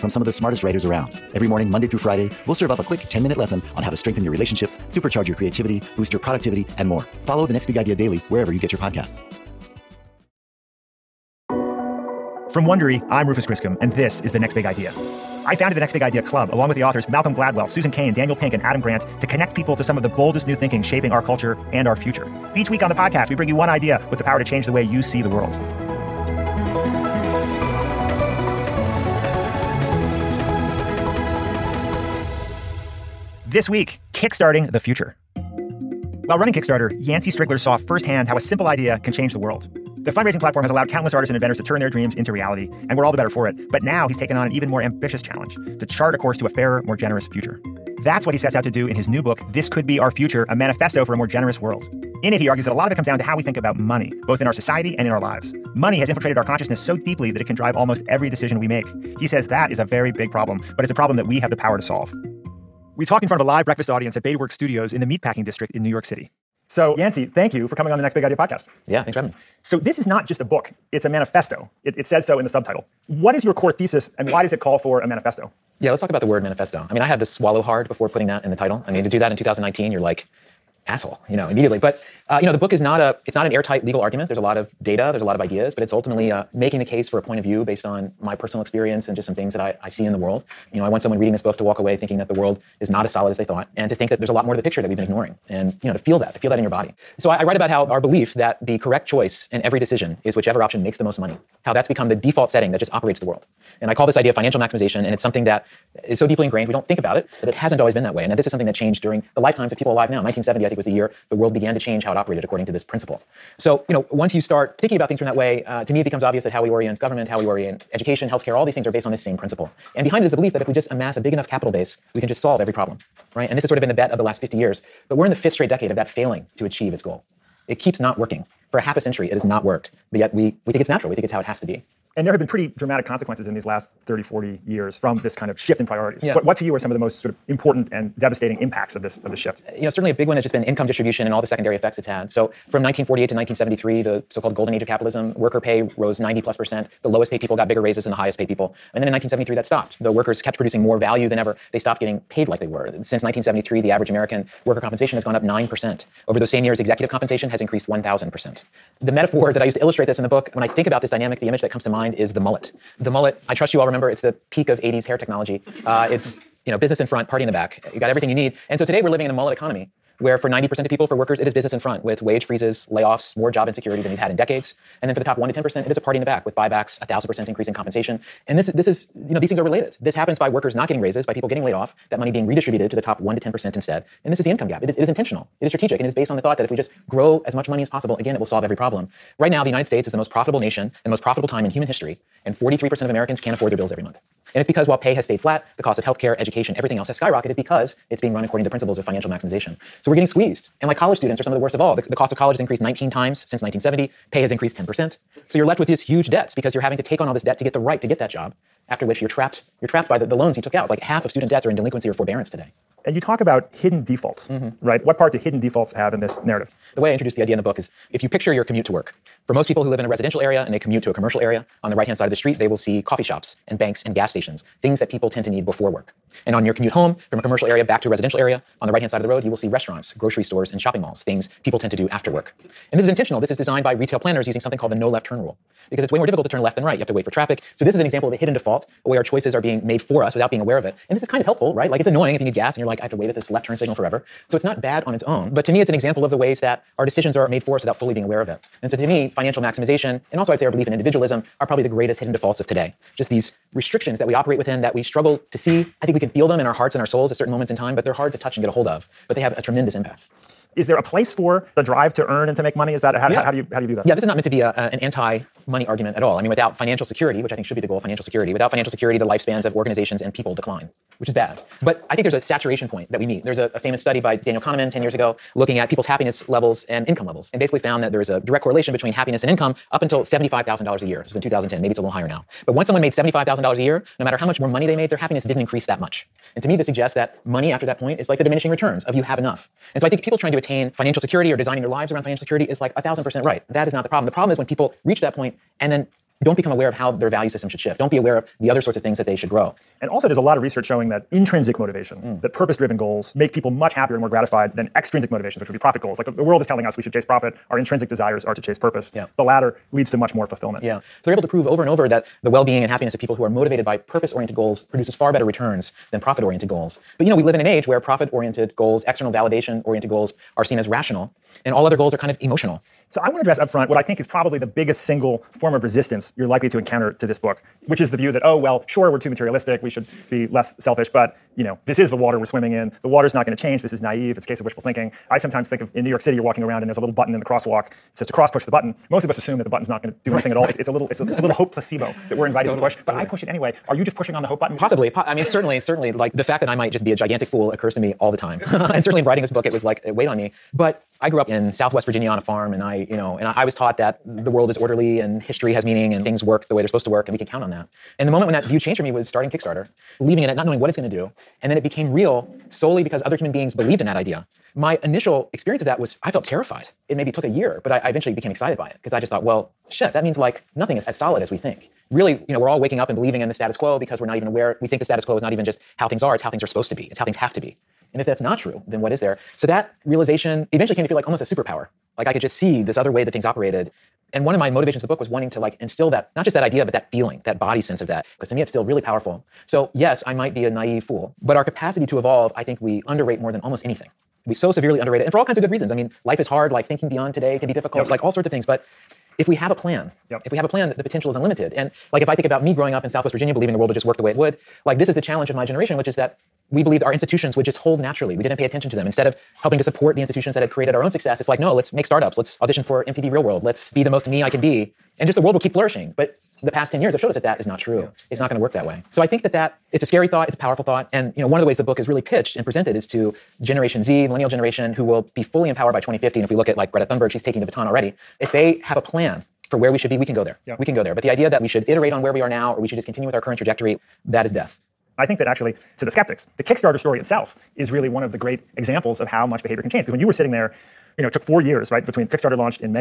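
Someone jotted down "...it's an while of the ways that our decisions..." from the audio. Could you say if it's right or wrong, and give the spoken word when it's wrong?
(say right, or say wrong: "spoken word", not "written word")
wrong: "example", not "while".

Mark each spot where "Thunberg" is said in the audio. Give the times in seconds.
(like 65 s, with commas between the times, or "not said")
427 s.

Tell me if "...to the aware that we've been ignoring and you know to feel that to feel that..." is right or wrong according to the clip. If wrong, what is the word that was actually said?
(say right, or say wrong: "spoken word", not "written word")
wrong: "picture", not "aware".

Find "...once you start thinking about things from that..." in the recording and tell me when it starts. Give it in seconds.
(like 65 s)
114 s.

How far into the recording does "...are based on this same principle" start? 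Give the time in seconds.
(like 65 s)
118 s.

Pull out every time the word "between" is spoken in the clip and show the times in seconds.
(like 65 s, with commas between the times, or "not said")
278 s, 442 s.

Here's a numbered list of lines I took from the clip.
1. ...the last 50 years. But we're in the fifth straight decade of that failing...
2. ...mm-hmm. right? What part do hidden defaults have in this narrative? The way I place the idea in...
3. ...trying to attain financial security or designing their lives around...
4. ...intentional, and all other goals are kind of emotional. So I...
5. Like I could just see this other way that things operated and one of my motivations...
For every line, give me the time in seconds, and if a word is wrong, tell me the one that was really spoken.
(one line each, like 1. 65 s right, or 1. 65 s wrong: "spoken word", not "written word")
1. 124 s right
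2. 214 s wrong: "introduce", not "place"
3. 290 s right
4. 320 s wrong: "rational", not "intentional"
5. 382 s right.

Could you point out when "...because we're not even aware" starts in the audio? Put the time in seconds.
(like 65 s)
373 s.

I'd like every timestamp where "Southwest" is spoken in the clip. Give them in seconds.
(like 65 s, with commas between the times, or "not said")
351 s, 403 s.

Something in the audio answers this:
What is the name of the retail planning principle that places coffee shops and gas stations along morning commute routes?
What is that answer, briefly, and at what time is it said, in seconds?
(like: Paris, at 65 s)
No left turn rule, at 234 s.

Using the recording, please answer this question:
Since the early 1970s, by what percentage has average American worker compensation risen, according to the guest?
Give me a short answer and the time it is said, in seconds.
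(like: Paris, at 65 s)
9%, at 155 s.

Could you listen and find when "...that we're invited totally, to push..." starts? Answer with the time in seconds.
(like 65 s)
342 s.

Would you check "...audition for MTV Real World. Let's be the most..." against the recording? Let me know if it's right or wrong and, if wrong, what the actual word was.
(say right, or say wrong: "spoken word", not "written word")
right.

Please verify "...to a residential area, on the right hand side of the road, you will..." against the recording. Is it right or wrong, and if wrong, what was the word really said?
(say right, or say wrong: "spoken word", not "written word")
right.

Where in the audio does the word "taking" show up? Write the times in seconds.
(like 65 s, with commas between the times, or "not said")
427 s.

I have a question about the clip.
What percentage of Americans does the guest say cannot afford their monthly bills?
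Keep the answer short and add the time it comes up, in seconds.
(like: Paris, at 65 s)
43%, at 192 s.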